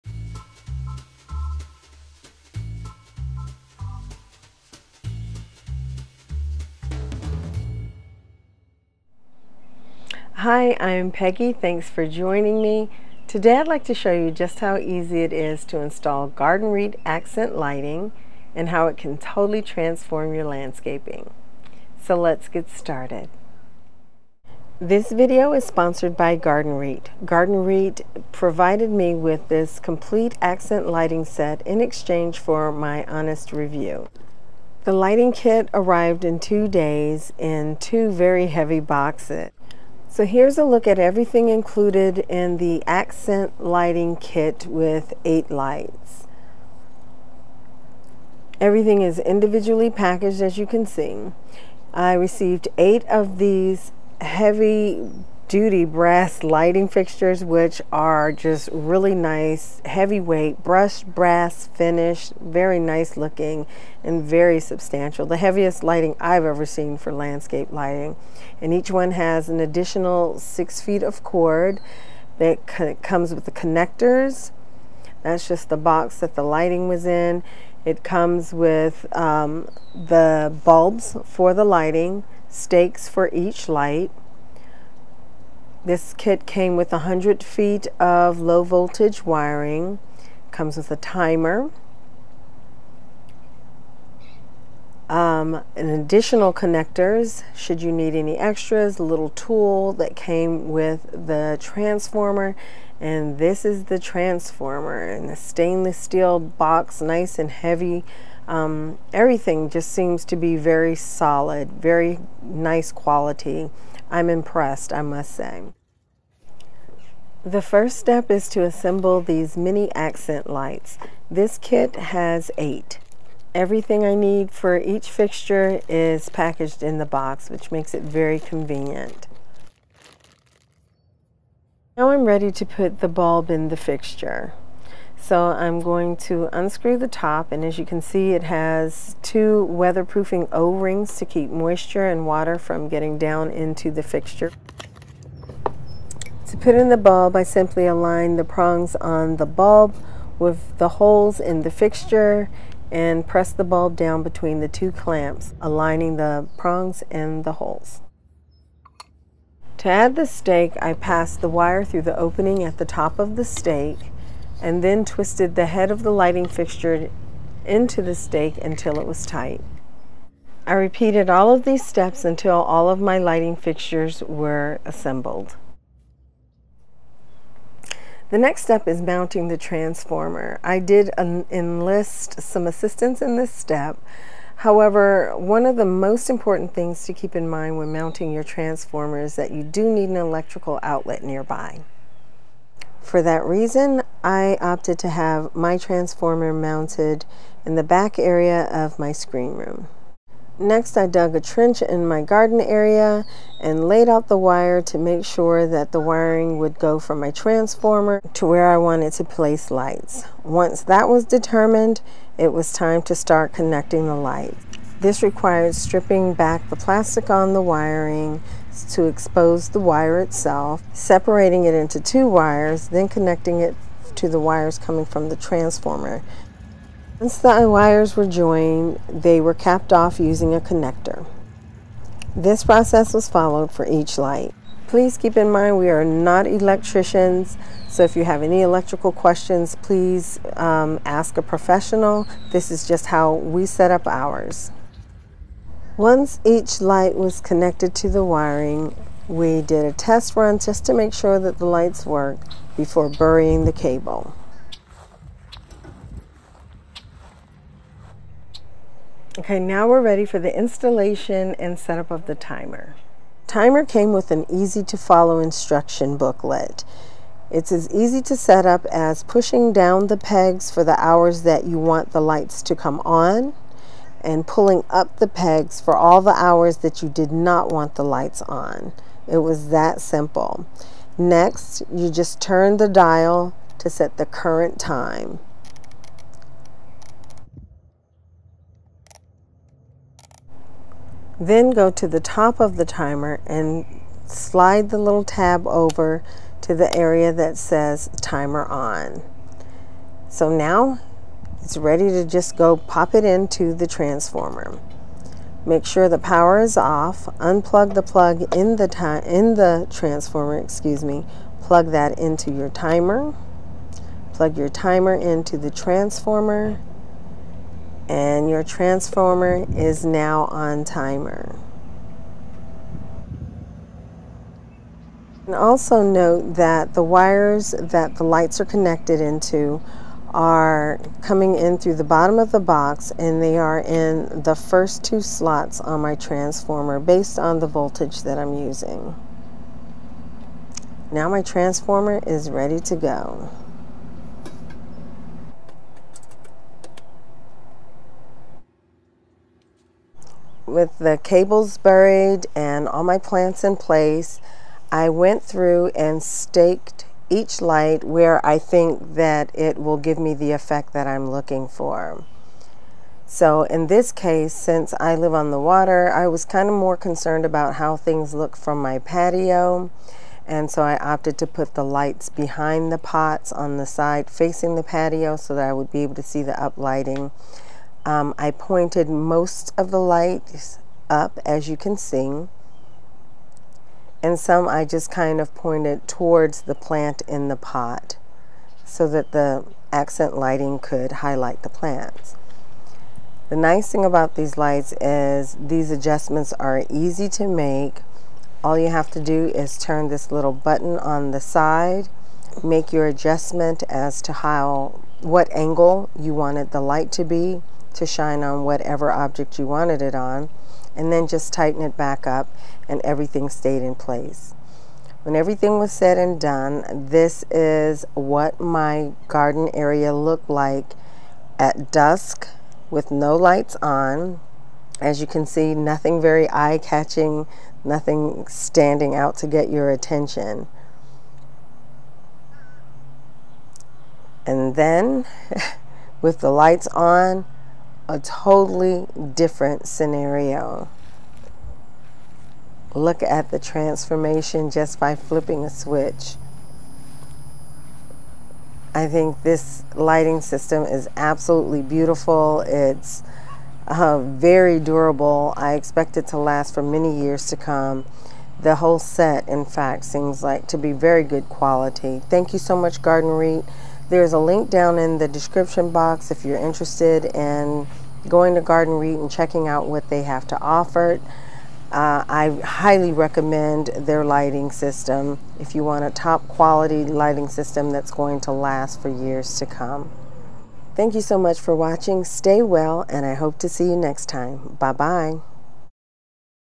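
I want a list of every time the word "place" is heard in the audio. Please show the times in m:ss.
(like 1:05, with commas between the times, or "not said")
3:29, 5:53, 6:53.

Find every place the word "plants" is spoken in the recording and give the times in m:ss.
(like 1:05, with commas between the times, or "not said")
5:53, 6:26, 6:31.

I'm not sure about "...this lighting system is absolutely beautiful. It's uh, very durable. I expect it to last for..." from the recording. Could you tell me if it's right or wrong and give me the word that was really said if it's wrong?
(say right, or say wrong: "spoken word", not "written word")
right.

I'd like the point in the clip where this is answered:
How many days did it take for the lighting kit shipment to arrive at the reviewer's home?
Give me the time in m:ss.
0:36.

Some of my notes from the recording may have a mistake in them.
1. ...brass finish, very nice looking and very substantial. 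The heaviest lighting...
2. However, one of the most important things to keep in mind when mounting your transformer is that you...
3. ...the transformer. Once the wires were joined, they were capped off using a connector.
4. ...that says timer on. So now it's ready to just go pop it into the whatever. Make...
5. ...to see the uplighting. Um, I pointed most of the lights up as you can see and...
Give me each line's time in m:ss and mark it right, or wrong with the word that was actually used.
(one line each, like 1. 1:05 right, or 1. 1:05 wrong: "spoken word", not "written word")
1. 1:01 right
2. 3:04 right
3. 3:45 right
4. 4:57 wrong: "transformer", not "whatever"
5. 6:16 right.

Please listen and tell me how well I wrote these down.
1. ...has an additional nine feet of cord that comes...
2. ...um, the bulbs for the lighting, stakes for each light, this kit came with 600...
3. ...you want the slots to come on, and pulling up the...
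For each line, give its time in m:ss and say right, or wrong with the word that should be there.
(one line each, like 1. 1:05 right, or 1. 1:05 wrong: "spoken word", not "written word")
1. 1:09 wrong: "six", not "nine"
2. 1:19 wrong: "100", not "600"
3. 4:31 wrong: "lights", not "slots".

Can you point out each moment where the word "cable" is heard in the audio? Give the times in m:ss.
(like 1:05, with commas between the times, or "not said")
4:13, 5:51.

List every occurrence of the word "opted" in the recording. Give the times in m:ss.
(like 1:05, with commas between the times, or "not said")
3:14, 6:10.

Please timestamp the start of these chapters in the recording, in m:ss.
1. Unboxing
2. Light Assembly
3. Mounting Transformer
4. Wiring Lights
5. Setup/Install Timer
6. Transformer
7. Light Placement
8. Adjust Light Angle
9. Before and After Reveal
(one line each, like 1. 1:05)
1. 0:28
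2. 2:02
3. 2:58
4. 3:23
5. 4:18
6. 5:23
7. 5:50
8. 6:39
9. 6:55.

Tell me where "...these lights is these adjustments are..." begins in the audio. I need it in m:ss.
6:34.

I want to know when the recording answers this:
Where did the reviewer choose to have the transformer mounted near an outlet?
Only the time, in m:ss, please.
3:19.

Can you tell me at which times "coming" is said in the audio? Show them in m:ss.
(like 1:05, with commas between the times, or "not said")
3:44, 5:31.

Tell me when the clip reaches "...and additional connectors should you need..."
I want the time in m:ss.
1:35.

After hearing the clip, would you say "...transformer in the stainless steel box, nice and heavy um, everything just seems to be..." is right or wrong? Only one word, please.
right.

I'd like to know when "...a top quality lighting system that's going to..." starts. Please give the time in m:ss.
7:56.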